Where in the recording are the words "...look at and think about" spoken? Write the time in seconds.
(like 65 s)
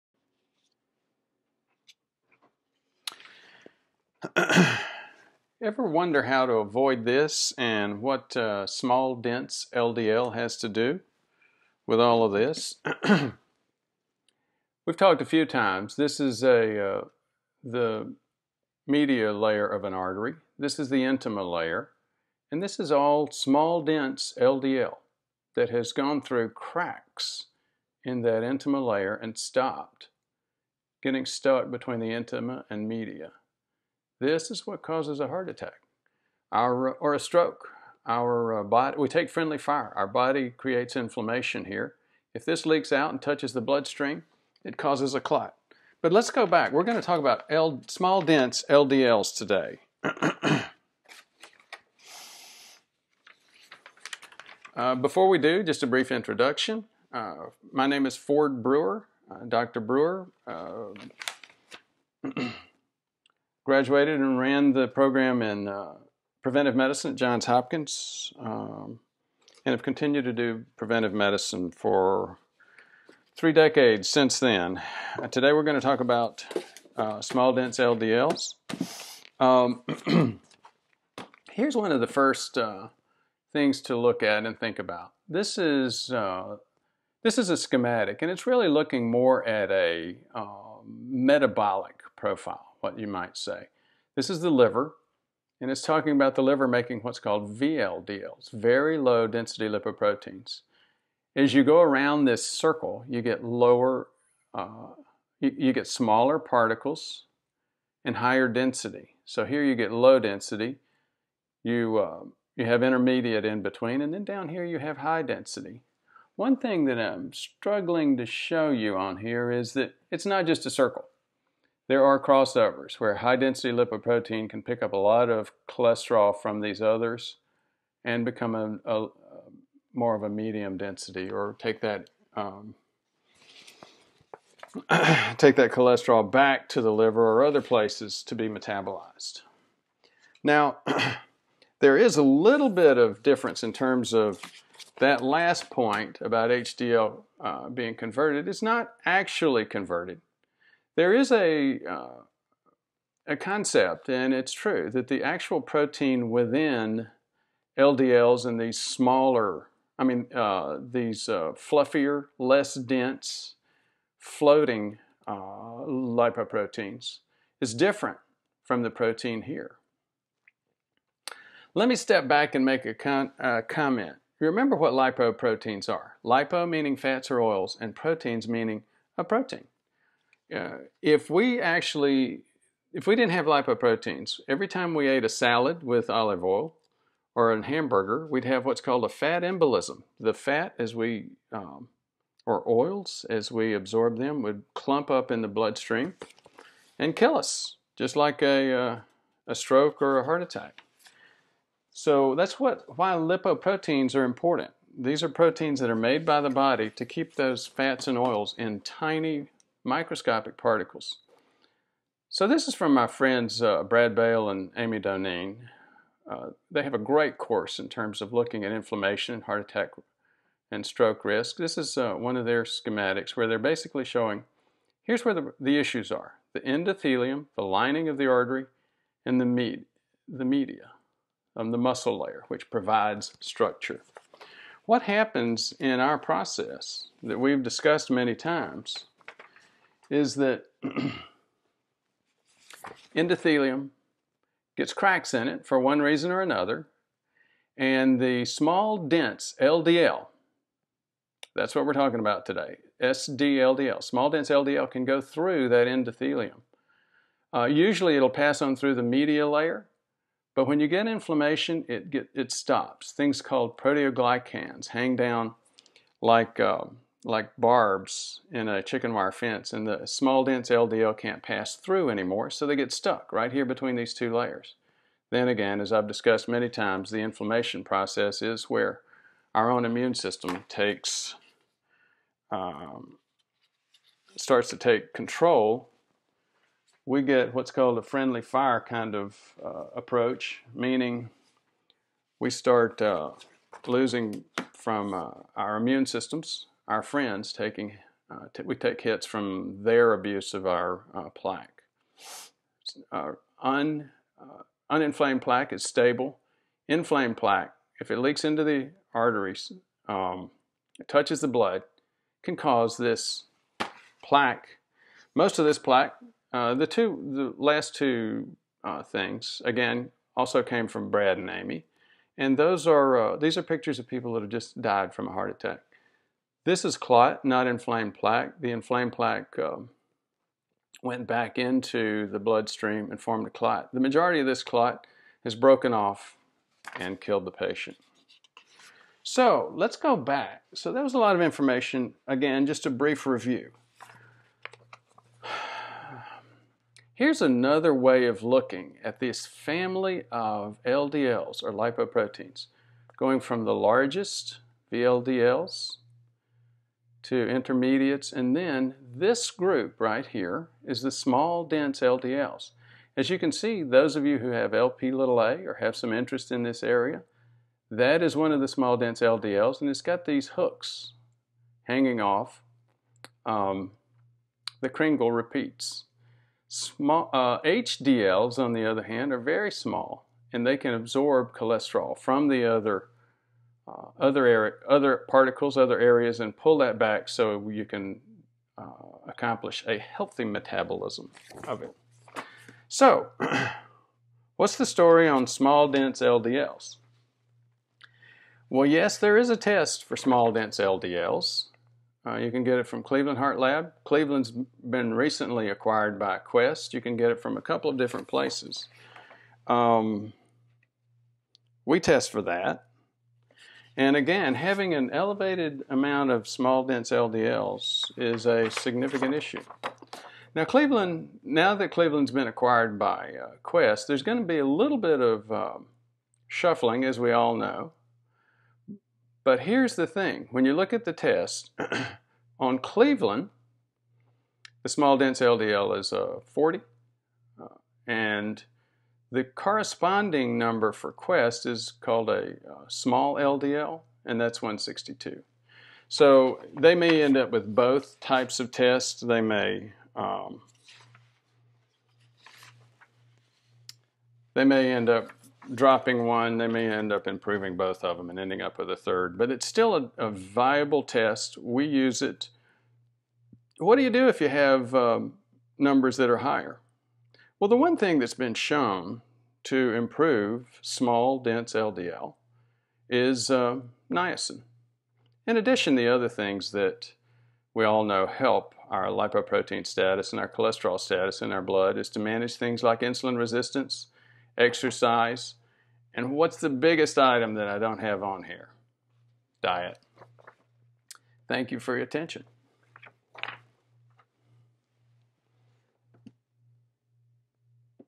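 83 s.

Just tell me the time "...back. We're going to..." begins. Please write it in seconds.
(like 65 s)
46 s.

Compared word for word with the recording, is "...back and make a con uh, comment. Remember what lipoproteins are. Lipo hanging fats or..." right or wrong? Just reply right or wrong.
wrong.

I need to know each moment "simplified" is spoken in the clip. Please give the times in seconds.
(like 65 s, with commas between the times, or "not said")
not said.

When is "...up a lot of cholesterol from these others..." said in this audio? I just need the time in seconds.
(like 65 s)
124 s.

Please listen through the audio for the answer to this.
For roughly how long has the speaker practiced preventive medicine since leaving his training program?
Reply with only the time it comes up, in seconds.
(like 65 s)
73 s.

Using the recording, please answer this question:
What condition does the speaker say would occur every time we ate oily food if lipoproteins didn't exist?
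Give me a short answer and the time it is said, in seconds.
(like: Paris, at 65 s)
fat embolism, at 189 s.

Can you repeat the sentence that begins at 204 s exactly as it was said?
These are proteins that are made by the body to keep those fats and oils in tiny microscopic particles.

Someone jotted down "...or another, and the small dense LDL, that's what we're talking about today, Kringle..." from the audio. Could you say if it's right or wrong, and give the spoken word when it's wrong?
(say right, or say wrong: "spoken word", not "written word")
wrong: "SDLDL", not "Kringle".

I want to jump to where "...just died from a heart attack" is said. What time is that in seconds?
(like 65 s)
324 s.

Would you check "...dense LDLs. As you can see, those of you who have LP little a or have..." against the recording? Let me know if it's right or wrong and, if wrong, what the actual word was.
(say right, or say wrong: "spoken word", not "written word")
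right.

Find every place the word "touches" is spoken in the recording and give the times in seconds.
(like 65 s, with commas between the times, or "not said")
43 s, 311 s.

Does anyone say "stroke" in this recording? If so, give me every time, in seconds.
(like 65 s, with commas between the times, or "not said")
37 s, 199 s, 220 s.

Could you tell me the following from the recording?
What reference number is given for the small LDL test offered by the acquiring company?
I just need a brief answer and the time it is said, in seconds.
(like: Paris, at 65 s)
162, at 444 s.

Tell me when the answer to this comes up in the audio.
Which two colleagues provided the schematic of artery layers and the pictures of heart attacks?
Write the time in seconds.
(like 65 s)
213 s.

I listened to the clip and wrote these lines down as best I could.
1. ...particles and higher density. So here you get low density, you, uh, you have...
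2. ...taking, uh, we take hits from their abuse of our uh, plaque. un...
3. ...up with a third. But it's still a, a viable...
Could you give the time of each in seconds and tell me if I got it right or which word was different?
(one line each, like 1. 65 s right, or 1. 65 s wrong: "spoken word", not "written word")
1. 106 s right
2. 297 s right
3. 458 s right.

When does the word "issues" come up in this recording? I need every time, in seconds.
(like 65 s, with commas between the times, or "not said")
225 s, 419 s.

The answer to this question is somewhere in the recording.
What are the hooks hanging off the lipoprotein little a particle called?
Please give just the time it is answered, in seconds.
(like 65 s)
374 s.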